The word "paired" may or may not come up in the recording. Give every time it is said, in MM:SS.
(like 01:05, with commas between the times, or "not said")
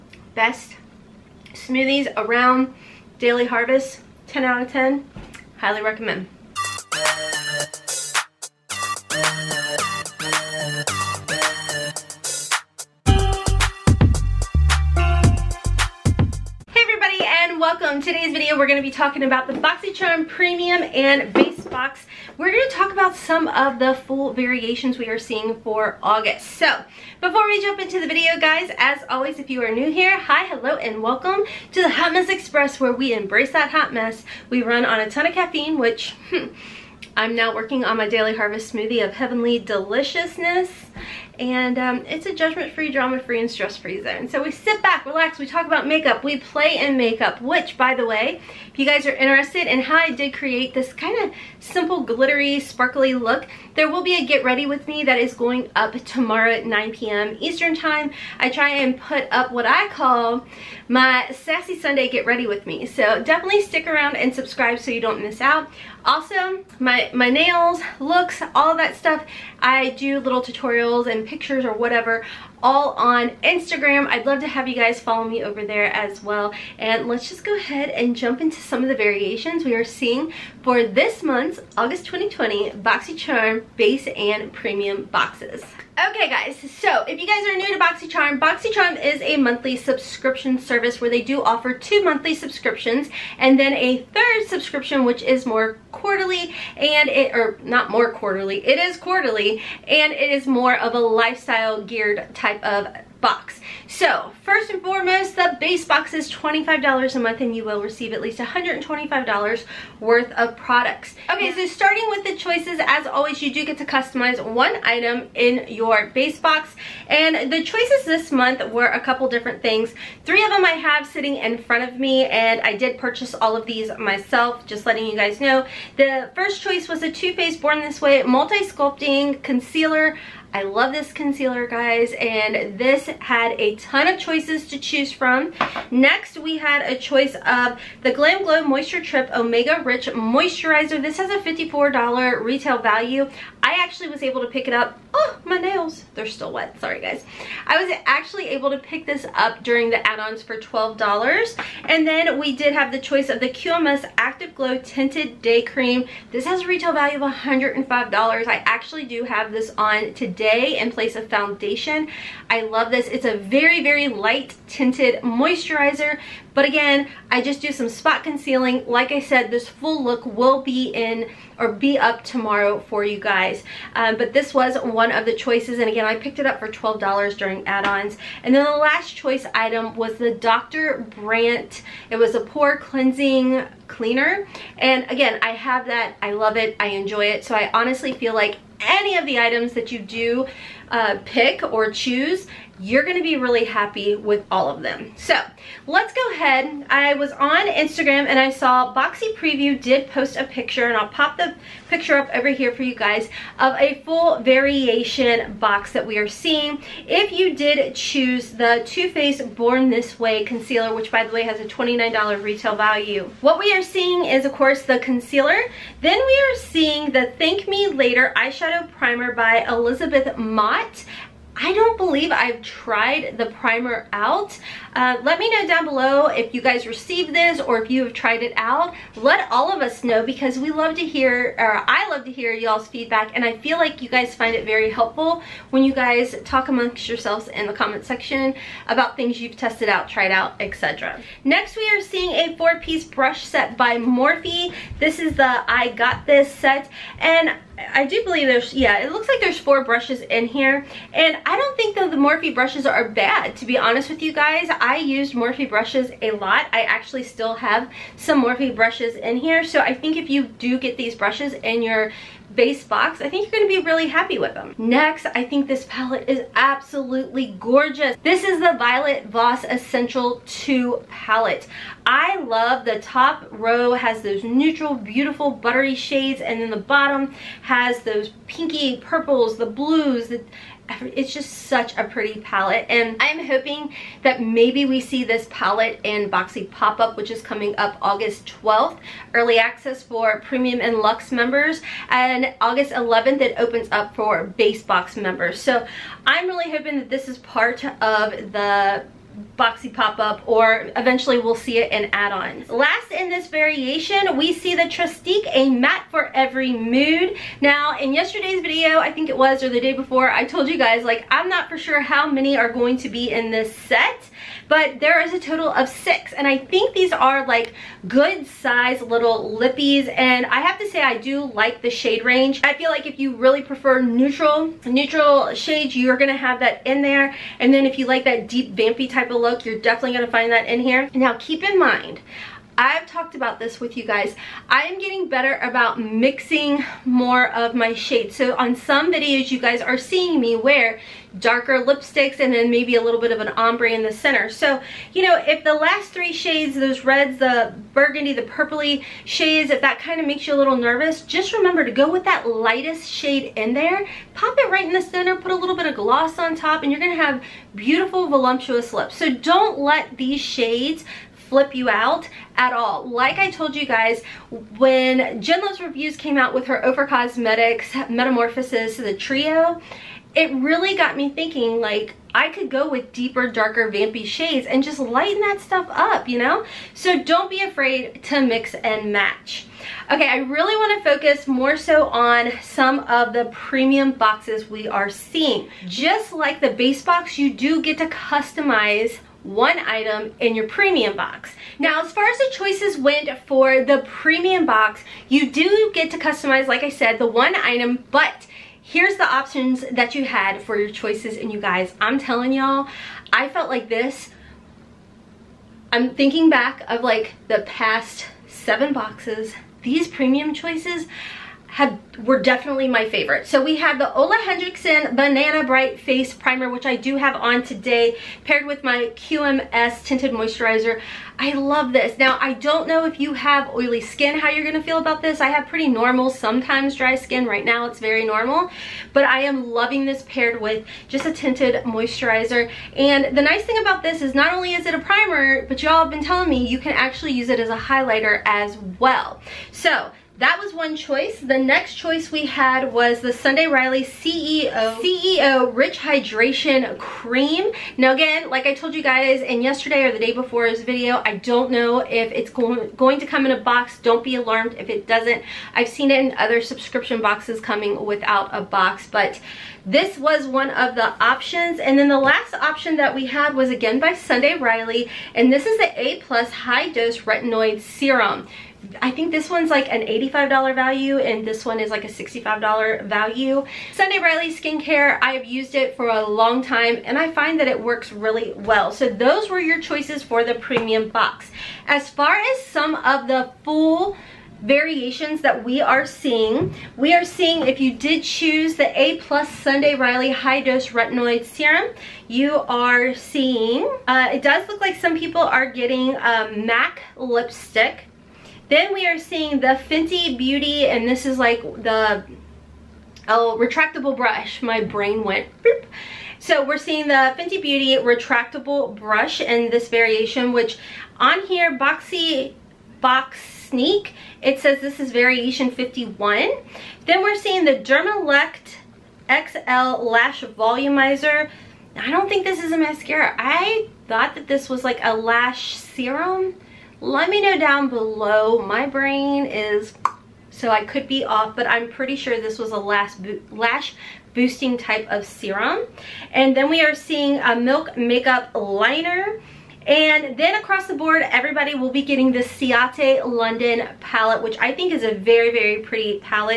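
06:58, 07:10.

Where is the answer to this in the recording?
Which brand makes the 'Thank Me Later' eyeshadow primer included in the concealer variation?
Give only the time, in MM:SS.
03:39.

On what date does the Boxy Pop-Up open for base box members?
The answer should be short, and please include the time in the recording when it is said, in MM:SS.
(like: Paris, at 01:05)
August 11, at 04:52.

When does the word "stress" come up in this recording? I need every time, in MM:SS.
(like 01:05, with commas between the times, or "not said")
00:43.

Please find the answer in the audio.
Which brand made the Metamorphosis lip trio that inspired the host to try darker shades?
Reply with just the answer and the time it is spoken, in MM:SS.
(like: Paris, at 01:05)
OFRA Cosmetics, at 06:06.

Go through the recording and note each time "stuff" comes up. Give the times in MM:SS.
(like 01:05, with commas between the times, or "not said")
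01:08, 06:15.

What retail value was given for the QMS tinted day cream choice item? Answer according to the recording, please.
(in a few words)
$105.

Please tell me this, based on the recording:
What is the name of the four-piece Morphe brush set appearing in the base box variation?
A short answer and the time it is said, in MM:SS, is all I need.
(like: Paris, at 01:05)
I Got This, at 04:05.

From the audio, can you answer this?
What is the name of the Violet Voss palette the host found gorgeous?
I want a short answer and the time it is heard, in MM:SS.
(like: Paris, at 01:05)
Essential 2, at 04:29.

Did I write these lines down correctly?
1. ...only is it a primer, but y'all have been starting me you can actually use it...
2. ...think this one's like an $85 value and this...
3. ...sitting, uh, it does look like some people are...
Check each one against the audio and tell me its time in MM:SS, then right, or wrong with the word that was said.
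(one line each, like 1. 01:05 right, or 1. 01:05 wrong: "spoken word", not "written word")
1. 07:14 wrong: "telling", not "starting"
2. 07:49 right
3. 08:13 wrong: "seeing", not "sitting".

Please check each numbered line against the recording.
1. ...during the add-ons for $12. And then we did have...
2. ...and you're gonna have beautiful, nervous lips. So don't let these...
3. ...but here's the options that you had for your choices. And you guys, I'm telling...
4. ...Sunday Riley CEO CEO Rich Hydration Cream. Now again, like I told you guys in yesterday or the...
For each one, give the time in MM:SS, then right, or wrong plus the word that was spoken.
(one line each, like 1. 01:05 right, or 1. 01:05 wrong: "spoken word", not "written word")
1. 02:29 right
2. 05:56 wrong: "voluptuous", not "nervous"
3. 06:38 right
4. 07:23 right.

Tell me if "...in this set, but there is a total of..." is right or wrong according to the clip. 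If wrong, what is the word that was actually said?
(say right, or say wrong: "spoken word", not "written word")
right.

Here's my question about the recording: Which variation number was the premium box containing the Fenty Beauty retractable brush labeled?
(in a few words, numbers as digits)
51.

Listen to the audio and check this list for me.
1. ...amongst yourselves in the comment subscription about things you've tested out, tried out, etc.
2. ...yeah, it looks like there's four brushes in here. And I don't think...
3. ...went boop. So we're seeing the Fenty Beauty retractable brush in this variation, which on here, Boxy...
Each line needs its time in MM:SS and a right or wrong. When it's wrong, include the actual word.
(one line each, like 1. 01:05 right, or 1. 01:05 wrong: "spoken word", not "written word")
1. 03:56 wrong: "section", not "subscription"
2. 04:08 right
3. 08:25 right.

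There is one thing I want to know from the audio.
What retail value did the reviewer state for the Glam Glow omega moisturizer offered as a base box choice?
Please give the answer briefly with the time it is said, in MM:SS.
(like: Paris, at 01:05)
$54, at 02:21.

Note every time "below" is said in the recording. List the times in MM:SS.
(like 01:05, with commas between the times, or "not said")
03:45, 08:47.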